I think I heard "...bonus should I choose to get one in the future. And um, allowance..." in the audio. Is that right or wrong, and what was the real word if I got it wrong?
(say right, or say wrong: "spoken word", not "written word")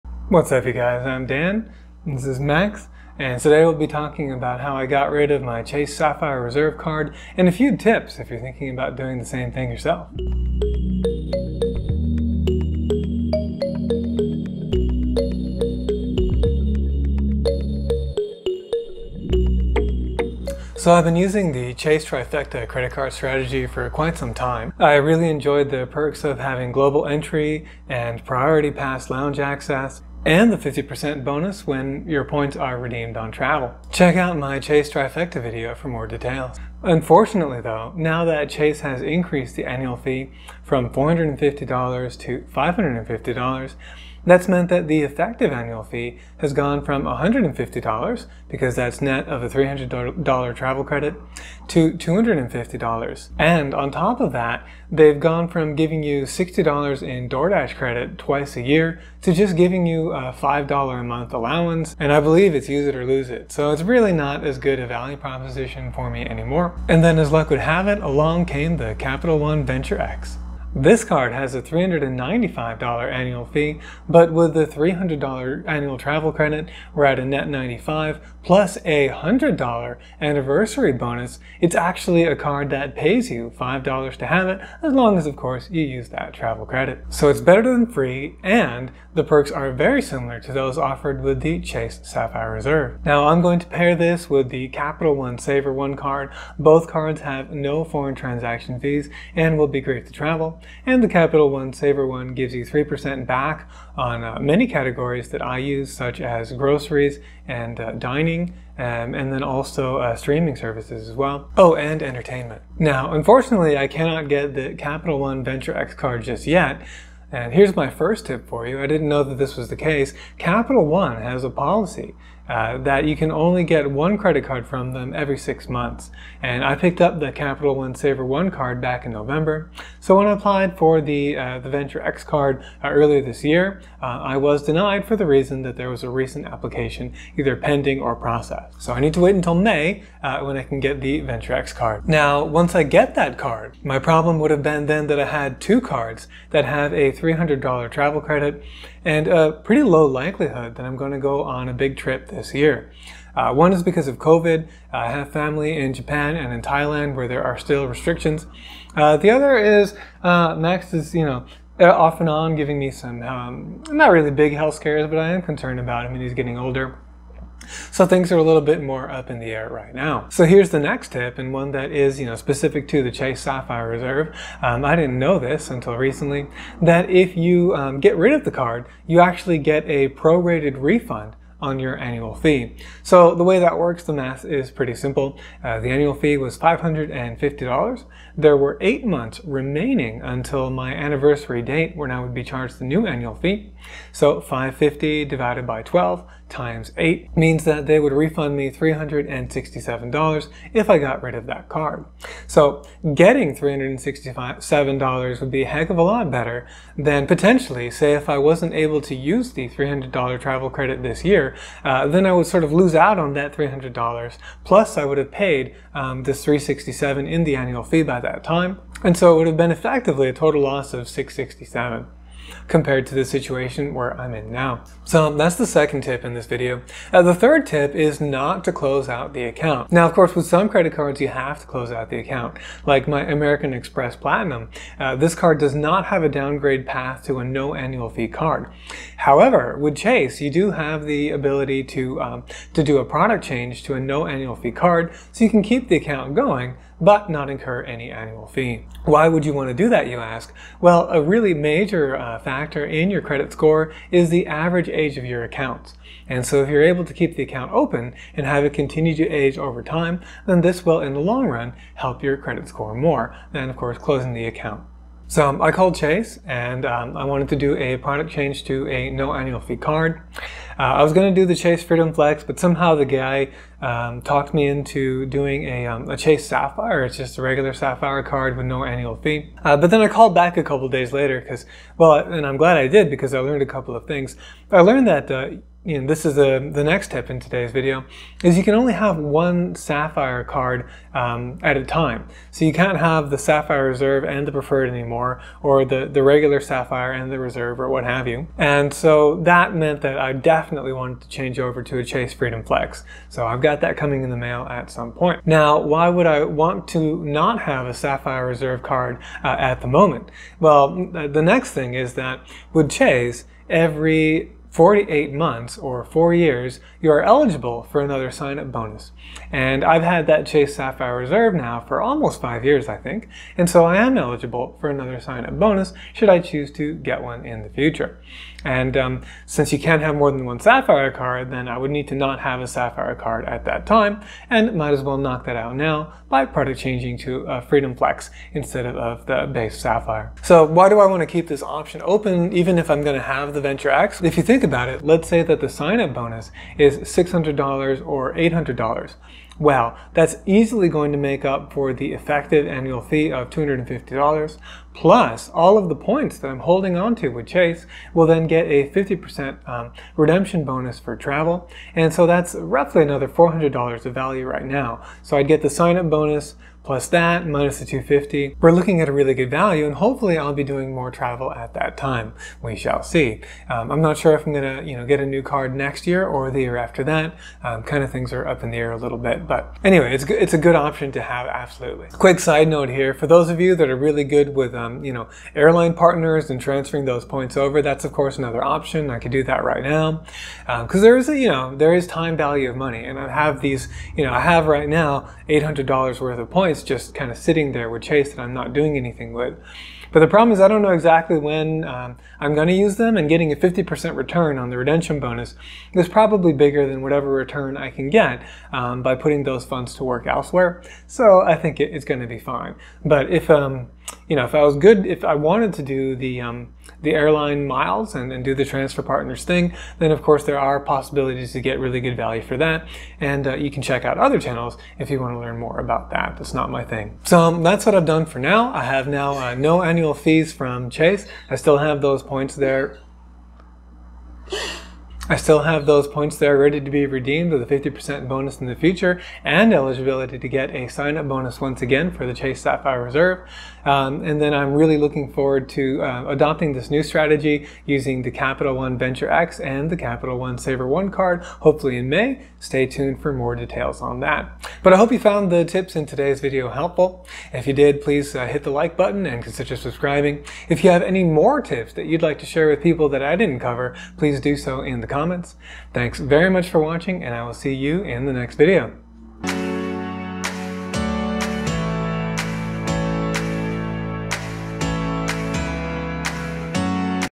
wrong: "since", not "allowance".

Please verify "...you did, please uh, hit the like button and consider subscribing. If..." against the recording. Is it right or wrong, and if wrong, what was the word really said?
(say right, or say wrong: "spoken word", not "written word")
right.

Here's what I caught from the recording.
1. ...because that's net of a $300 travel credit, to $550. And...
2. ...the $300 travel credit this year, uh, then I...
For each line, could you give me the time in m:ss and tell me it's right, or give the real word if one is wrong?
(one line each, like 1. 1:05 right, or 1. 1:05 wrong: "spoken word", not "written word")
1. 0:48 wrong: "250", not "550"
2. 3:29 right.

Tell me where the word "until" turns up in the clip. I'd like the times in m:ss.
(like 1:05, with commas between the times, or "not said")
2:19, 2:55, 3:10.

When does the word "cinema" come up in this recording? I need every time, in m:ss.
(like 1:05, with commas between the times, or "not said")
not said.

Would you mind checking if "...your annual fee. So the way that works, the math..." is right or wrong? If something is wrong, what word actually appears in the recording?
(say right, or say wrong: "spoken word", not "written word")
right.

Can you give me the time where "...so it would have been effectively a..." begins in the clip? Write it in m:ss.
3:39.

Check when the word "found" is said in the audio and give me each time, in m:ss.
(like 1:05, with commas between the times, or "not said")
7:35.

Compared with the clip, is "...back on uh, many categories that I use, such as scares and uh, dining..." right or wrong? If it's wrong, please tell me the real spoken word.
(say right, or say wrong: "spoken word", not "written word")
wrong: "groceries", not "scares".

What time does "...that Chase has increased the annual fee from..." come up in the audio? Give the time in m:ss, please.
0:38.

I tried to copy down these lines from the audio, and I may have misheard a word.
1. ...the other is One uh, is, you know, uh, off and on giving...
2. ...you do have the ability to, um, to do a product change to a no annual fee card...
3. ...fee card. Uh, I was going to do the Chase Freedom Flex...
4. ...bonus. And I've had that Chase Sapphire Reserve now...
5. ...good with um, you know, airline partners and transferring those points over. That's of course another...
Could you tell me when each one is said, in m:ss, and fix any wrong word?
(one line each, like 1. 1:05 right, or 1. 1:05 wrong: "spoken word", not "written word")
1. 2:39 wrong: "Max", not "One"
2. 4:00 right
3. 4:29 right
4. 5:18 right
5. 6:24 right.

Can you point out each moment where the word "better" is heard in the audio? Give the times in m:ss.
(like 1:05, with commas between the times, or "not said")
1:27, 3:26.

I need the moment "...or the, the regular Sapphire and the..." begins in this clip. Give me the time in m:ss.
4:55.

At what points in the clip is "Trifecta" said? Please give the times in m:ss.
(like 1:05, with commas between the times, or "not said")
0:22, 0:34.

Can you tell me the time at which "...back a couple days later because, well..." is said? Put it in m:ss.
4:40.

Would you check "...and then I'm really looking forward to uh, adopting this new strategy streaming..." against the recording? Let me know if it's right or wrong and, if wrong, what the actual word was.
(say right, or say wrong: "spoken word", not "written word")
wrong: "using", not "streaming".